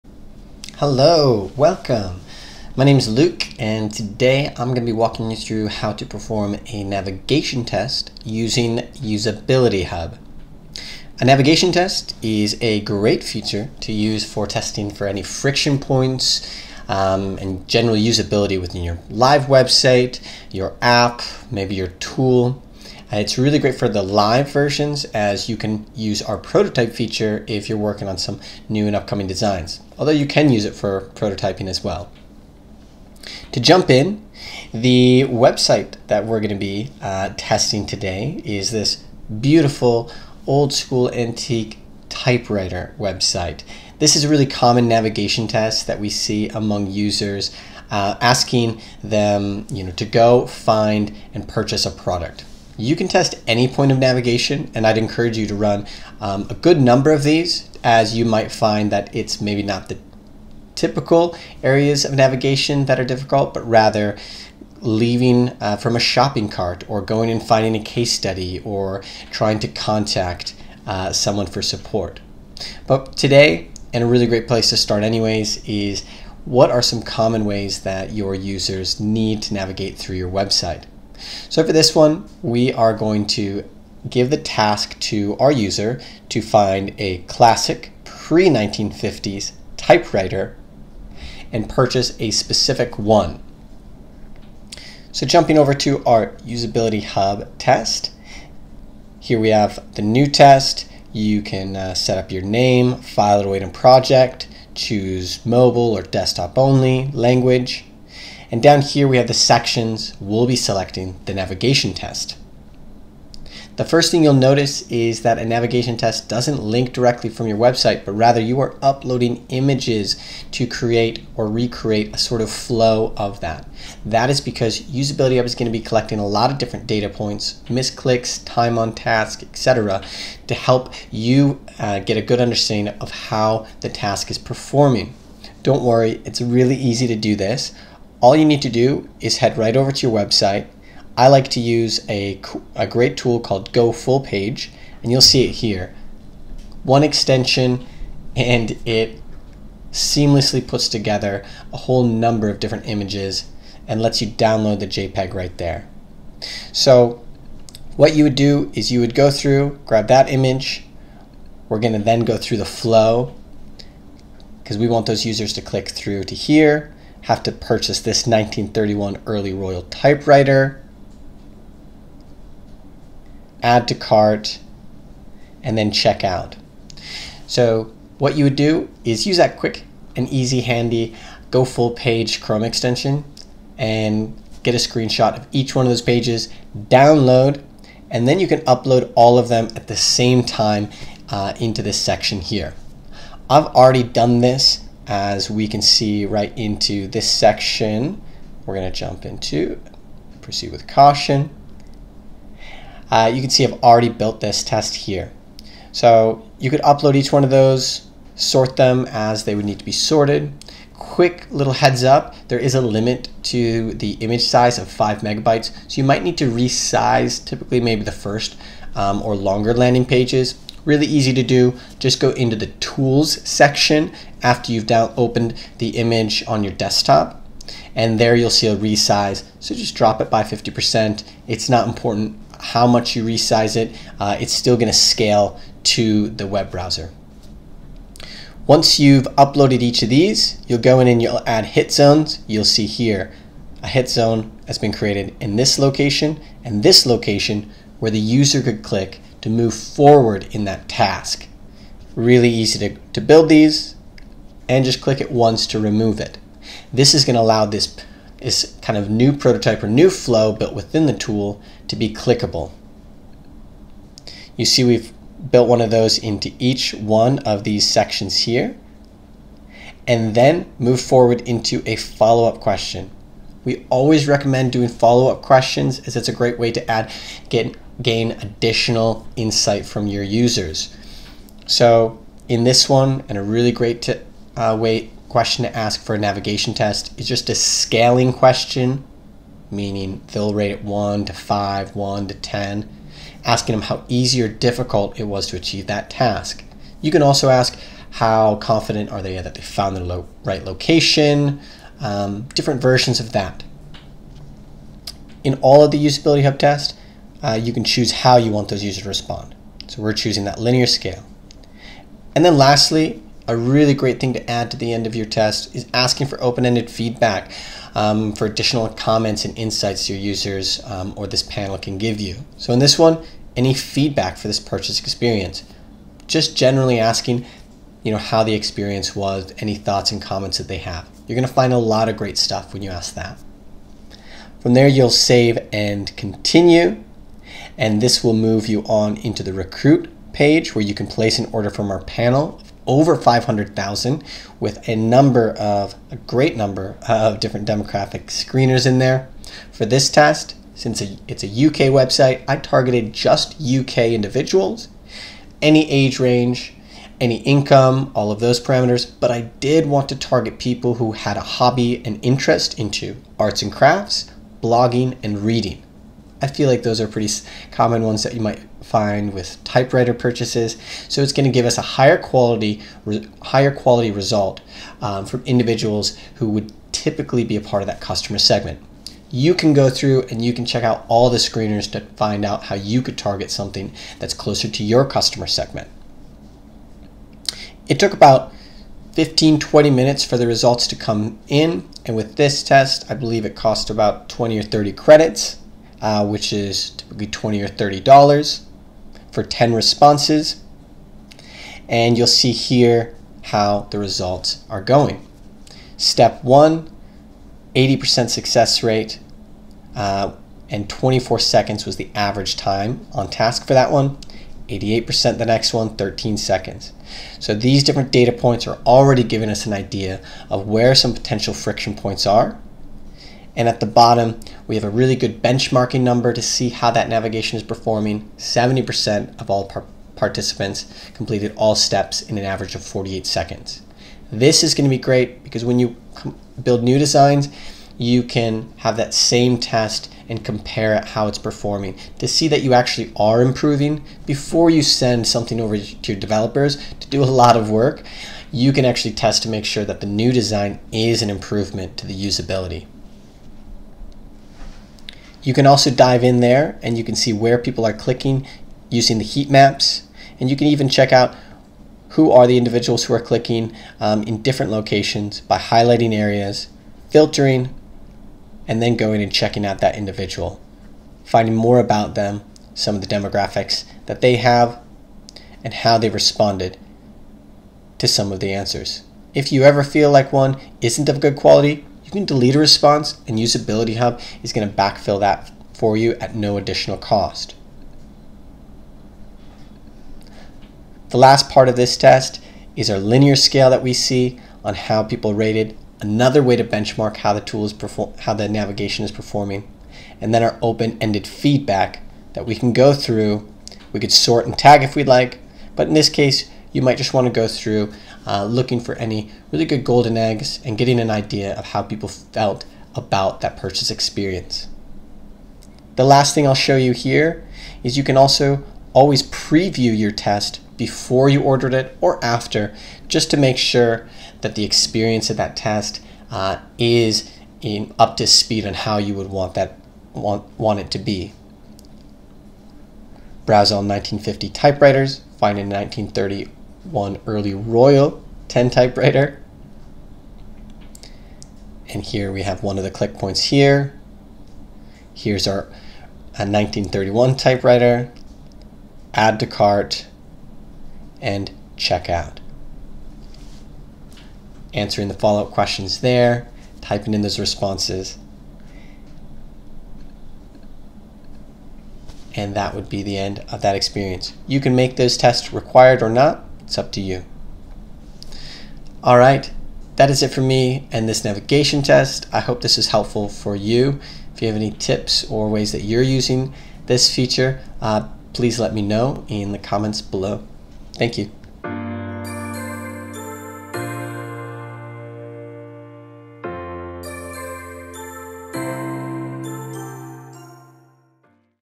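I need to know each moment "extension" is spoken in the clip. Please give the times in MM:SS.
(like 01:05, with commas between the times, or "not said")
02:27, 03:02.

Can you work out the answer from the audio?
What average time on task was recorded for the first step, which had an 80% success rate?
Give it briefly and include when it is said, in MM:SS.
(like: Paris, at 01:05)
24 seconds, at 06:50.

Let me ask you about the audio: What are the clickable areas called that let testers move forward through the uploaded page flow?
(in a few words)
hit zones.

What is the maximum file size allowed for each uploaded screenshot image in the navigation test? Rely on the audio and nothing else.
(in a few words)
5 megabytes.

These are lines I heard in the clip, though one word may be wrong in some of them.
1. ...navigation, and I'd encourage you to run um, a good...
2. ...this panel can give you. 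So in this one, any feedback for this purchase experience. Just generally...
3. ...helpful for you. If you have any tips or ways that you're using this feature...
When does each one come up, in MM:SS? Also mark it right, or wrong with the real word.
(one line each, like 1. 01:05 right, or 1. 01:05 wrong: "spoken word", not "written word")
1. 00:53 right
2. 05:21 right
3. 09:32 right.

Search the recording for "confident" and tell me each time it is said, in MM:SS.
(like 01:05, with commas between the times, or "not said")
04:58.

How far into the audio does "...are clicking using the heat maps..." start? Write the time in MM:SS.
07:37.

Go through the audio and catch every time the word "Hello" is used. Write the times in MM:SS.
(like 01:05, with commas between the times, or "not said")
00:00.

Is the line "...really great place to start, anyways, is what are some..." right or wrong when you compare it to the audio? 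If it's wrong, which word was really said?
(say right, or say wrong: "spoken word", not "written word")
right.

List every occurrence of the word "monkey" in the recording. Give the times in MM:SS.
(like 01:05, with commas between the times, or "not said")
not said.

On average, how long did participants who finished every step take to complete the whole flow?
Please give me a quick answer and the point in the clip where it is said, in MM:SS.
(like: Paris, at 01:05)
48 seconds, at 07:12.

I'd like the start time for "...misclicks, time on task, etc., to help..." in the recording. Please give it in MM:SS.
02:07.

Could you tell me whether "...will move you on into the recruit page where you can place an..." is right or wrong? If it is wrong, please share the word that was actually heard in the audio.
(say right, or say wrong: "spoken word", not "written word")
right.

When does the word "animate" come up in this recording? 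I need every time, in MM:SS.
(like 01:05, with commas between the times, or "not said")
not said.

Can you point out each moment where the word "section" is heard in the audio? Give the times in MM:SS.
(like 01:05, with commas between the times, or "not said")
01:49, 03:11, 03:17, 03:43, 04:27.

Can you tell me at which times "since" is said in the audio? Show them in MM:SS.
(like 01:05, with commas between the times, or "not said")
05:50.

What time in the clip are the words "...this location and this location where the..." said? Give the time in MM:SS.
04:05.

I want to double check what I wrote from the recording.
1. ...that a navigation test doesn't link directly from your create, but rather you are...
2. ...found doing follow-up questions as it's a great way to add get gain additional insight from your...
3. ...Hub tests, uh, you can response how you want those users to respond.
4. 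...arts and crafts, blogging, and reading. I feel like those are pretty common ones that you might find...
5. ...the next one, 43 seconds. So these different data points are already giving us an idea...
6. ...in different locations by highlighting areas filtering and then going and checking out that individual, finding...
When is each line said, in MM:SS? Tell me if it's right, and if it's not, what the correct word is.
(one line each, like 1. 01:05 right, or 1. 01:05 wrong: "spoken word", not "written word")
1. 01:55 wrong: "website", not "create"
2. 04:34 wrong: "recommend", not "found"
3. 05:06 wrong: "choose", not "response"
4. 06:03 right
5. 06:55 wrong: "13", not "43"
6. 07:44 right.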